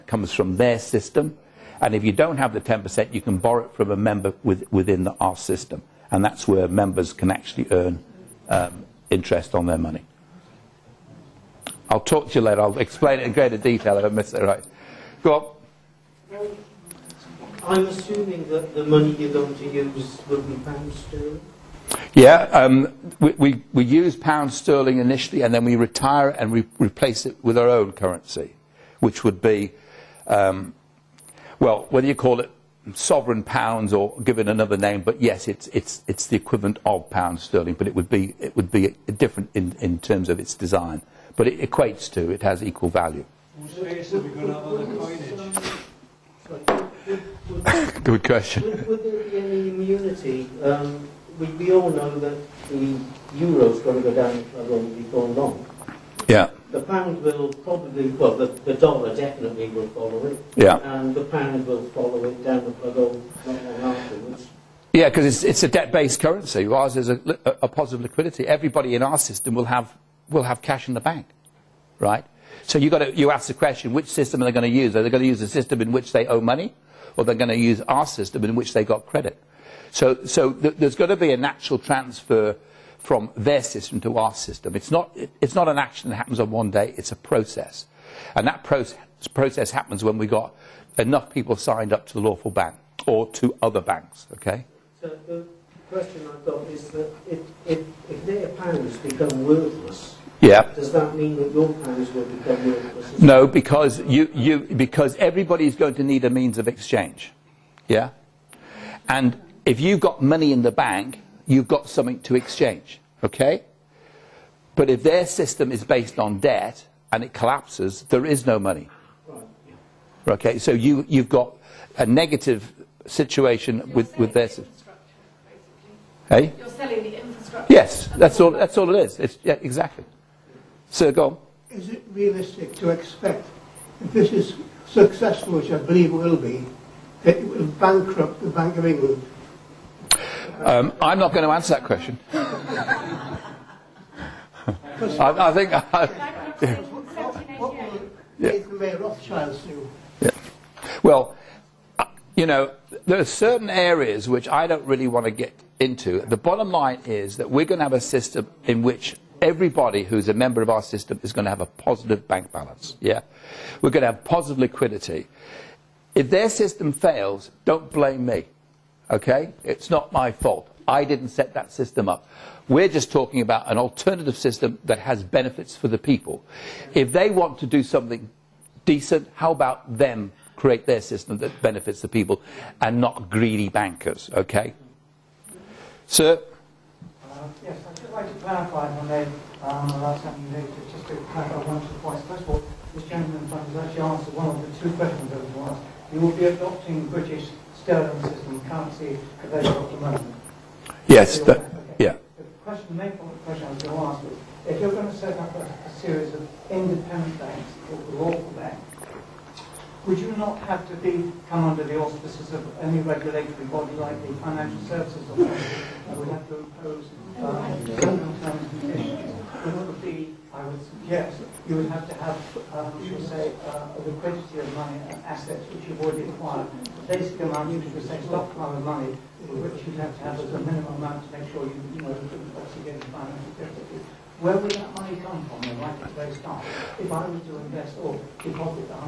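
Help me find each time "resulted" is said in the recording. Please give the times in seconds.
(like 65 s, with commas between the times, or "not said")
not said.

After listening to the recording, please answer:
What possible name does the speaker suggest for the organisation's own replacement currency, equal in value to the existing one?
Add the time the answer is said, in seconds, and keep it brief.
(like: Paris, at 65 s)
sovereign pounds, at 32 s.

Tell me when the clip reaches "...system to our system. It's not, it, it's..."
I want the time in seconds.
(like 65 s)
83 s.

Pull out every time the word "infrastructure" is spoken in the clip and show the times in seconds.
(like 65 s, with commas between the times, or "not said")
127 s.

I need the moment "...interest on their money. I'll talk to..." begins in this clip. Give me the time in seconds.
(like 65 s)
9 s.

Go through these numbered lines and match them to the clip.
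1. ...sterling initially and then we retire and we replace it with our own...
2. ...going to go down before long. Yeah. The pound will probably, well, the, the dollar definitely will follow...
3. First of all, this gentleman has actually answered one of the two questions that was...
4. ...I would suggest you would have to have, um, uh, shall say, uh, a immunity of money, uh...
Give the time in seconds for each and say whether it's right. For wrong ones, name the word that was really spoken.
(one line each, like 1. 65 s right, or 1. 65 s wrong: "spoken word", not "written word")
1. 24 s right
2. 53 s right
3. 192 s right
4. 220 s wrong: "liquidity", not "immunity".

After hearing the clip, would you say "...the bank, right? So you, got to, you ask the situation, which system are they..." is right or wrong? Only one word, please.
wrong.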